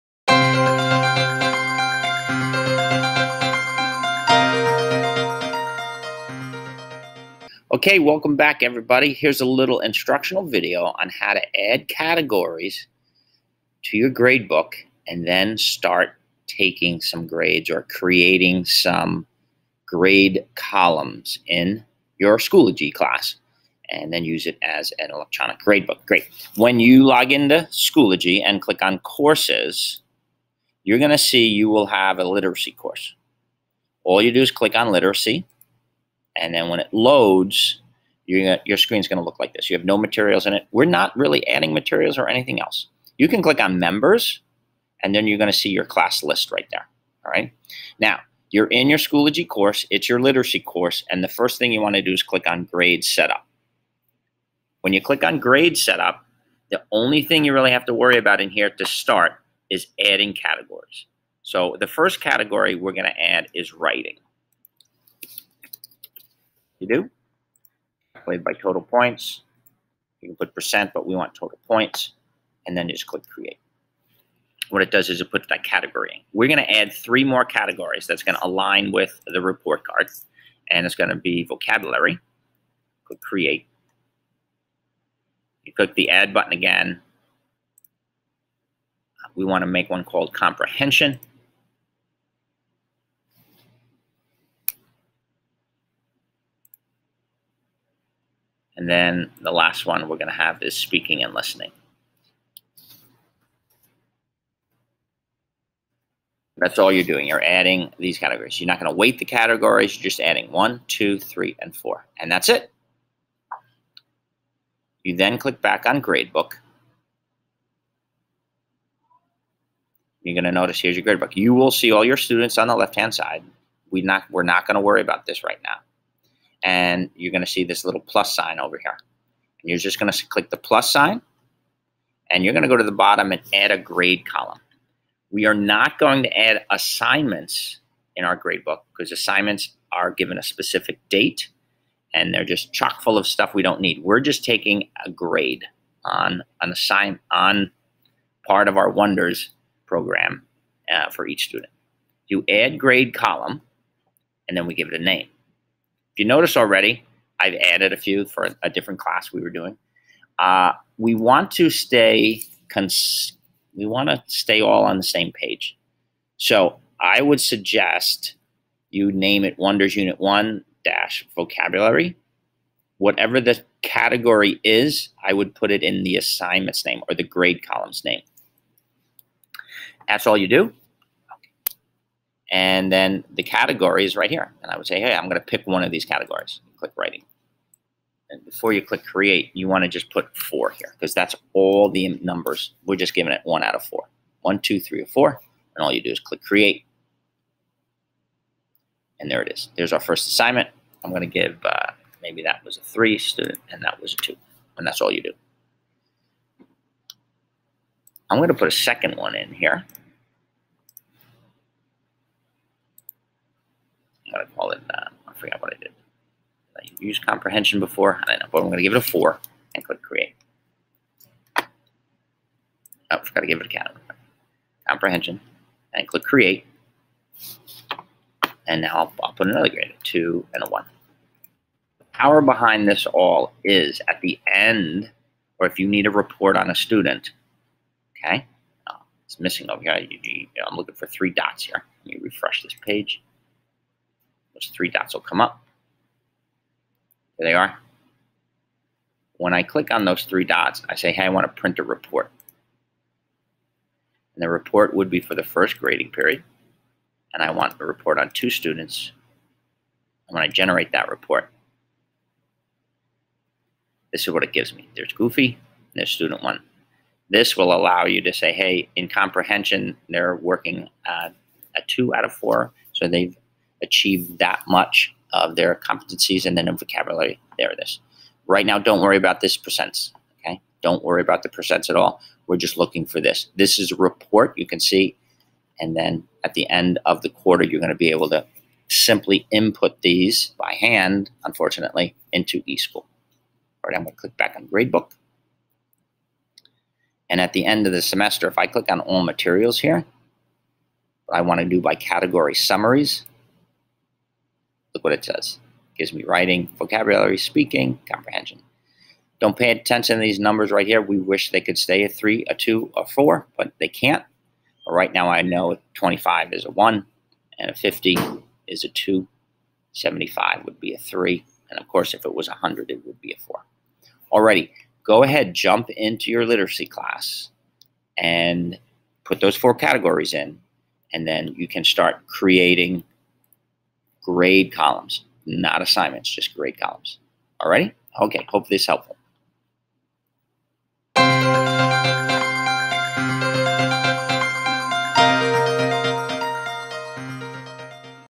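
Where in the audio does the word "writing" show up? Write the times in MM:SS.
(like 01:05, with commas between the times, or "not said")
01:03, 03:06, 05:06.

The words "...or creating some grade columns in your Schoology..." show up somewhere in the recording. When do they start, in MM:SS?
00:17.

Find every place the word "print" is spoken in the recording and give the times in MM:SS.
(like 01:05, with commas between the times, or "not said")
04:11.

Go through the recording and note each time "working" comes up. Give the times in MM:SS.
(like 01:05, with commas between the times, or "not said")
04:30.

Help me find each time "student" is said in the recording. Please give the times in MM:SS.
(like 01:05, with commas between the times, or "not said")
02:02, 02:31, 03:23, 03:56, 04:18, 04:26.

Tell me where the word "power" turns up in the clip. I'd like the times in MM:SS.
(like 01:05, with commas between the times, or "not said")
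03:52.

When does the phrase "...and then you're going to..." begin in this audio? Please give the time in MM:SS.
00:45.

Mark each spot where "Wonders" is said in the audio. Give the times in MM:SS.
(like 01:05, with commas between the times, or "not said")
02:28, 02:49.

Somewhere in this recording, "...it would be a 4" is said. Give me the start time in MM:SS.
05:22.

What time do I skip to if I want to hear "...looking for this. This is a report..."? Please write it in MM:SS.
04:42.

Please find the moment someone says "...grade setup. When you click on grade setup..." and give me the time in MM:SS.
00:52.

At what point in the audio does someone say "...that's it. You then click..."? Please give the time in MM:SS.
01:52.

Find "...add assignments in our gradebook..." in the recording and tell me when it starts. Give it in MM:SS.
02:16.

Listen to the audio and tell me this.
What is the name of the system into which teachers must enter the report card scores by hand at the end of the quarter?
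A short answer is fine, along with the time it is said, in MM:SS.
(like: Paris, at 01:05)
eSchool, at 04:52.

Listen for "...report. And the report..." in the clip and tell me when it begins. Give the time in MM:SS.
04:11.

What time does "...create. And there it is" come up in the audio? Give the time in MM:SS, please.
03:16.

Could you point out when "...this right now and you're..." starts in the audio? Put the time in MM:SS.
02:05.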